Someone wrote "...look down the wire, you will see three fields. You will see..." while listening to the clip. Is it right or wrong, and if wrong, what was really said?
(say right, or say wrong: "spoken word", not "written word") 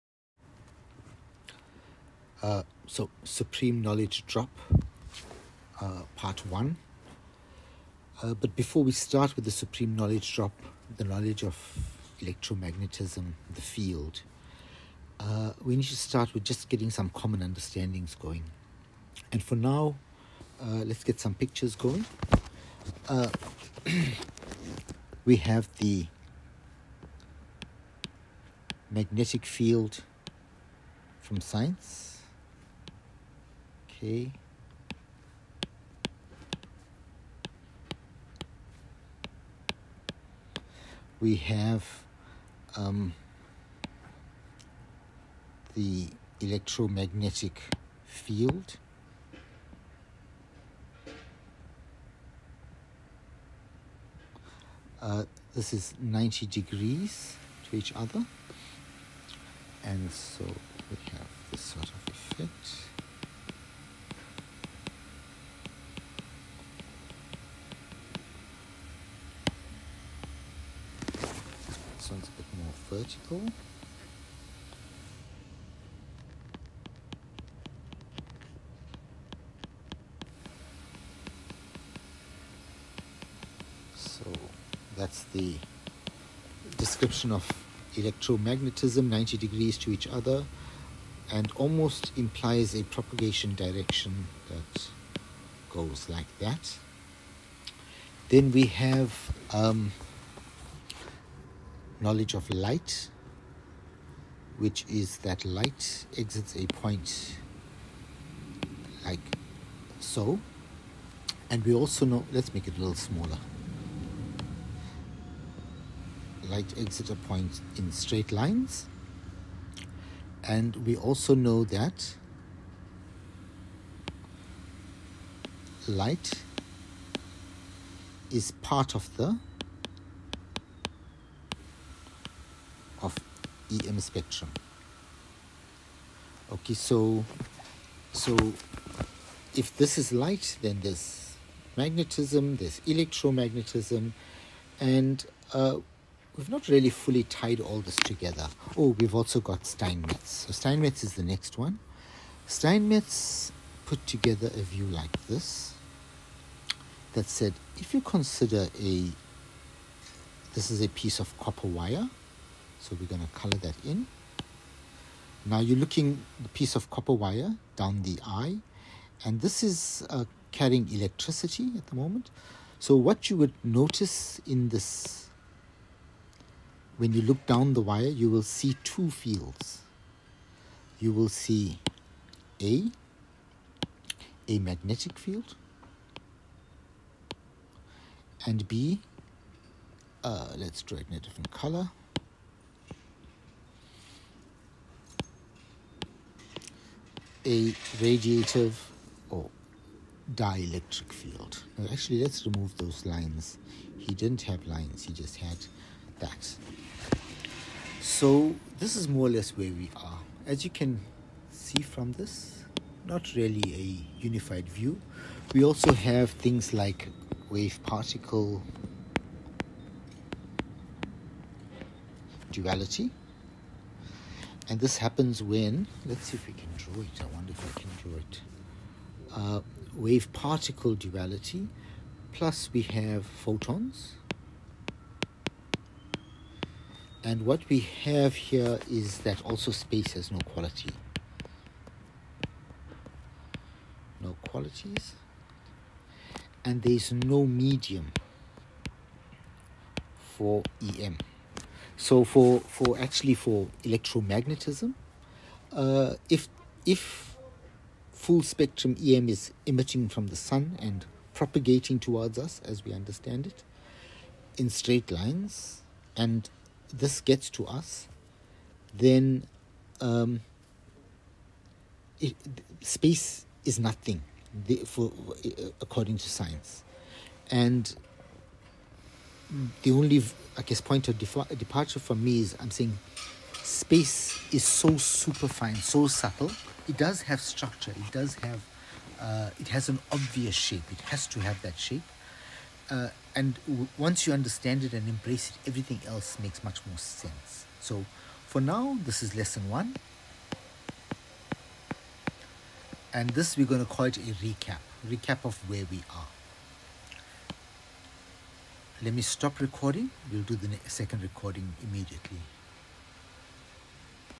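wrong: "two", not "three".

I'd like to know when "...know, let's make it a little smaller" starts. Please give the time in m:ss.
1:52.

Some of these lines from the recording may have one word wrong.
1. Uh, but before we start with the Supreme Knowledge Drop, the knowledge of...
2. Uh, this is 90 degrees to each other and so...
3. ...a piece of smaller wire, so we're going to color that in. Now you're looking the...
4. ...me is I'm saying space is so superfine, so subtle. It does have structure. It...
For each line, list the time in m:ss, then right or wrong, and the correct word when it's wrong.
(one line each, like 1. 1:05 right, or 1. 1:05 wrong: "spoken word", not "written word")
1. 0:08 right
2. 0:54 right
3. 2:40 wrong: "copper", not "smaller"
4. 4:42 right.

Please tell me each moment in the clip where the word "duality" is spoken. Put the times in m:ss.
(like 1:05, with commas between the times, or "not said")
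3:42, 3:50.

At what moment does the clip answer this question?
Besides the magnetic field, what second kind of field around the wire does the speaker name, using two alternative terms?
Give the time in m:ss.
3:17.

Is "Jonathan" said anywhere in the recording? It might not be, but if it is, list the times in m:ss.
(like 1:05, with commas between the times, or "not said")
not said.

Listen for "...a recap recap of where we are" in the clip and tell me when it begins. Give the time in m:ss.
5:04.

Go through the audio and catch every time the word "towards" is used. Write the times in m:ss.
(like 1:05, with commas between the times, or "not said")
4:21.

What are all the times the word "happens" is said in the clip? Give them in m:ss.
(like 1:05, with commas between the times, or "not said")
3:44.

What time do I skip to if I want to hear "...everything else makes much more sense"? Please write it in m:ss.
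4:55.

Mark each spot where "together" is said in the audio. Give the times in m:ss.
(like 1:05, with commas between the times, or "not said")
2:27, 2:34.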